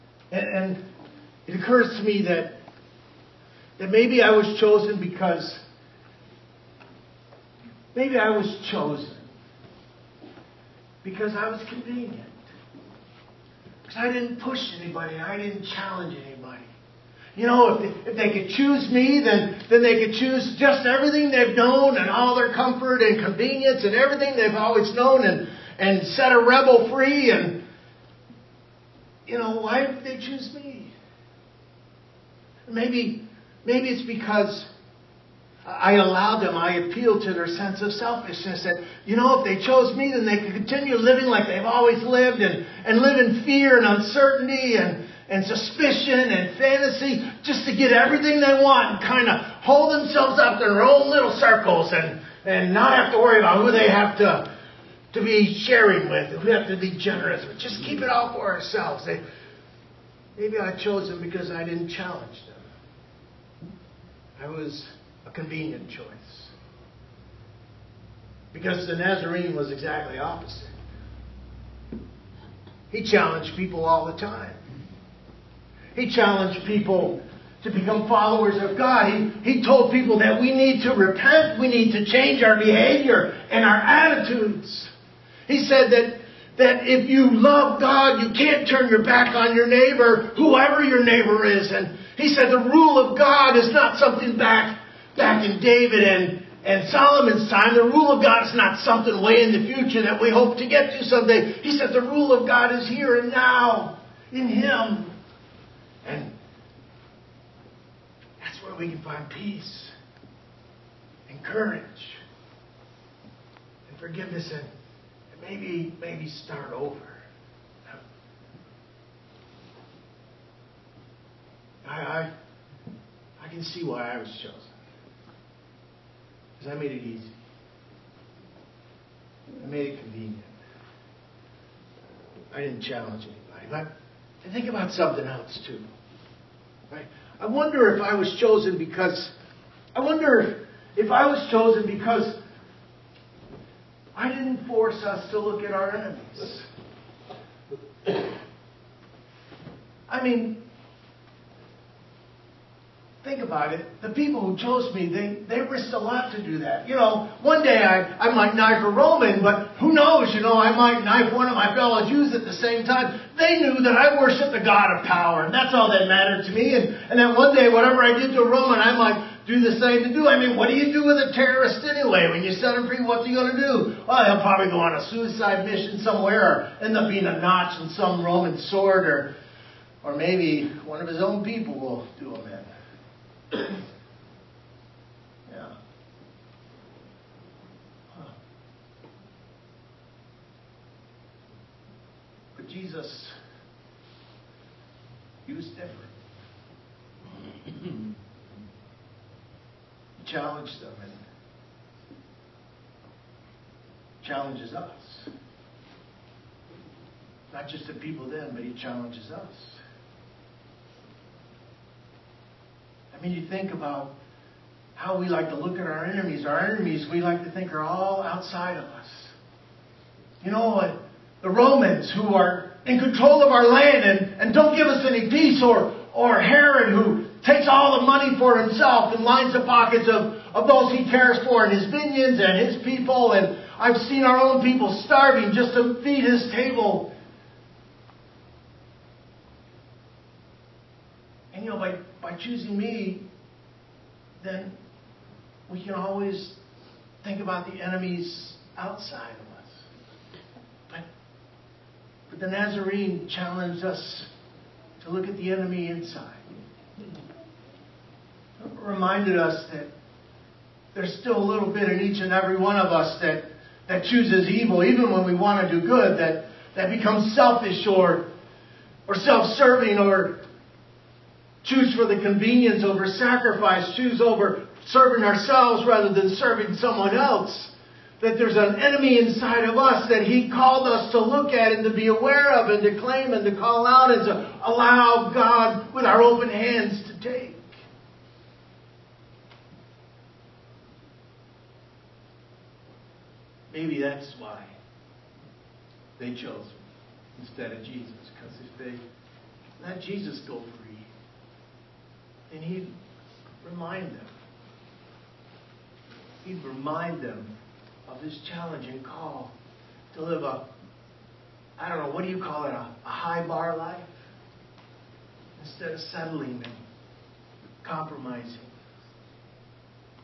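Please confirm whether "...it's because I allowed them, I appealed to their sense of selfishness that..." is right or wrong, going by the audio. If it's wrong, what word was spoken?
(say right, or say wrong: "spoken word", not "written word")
right.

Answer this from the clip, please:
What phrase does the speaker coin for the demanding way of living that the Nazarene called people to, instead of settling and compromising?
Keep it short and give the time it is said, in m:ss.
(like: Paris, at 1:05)
A high bar life, at 5:13.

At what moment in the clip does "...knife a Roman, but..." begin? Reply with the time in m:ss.
2:38.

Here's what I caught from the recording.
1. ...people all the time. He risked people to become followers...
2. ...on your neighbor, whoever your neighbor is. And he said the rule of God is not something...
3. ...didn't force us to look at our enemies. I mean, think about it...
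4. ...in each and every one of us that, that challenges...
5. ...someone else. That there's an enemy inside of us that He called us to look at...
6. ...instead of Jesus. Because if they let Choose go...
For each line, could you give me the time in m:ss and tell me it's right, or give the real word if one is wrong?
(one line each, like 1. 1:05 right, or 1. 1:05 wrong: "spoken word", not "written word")
1. 1:13 wrong: "challenged", not "risked"
2. 1:29 right
3. 2:24 right
4. 4:21 wrong: "chooses", not "challenges"
5. 4:36 right
6. 4:57 wrong: "Jesus", not "Choose".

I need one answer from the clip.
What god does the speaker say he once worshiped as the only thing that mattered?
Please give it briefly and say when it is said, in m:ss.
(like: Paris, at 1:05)
The God of power, at 2:44.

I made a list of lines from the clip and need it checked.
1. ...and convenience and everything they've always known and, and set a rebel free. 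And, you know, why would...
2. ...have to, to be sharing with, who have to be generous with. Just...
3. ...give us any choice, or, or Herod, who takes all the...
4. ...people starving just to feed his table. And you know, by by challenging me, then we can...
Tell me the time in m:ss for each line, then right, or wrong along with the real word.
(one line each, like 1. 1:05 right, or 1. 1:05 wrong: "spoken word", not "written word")
1. 0:23 right
2. 0:53 right
3. 3:44 wrong: "peace", not "choice"
4. 3:54 wrong: "choosing", not "challenging".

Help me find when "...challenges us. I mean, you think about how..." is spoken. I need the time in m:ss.
3:28.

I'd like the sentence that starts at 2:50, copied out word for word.
I mean, what do you do with a terrorist anyway?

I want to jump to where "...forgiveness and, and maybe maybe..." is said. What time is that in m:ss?
1:53.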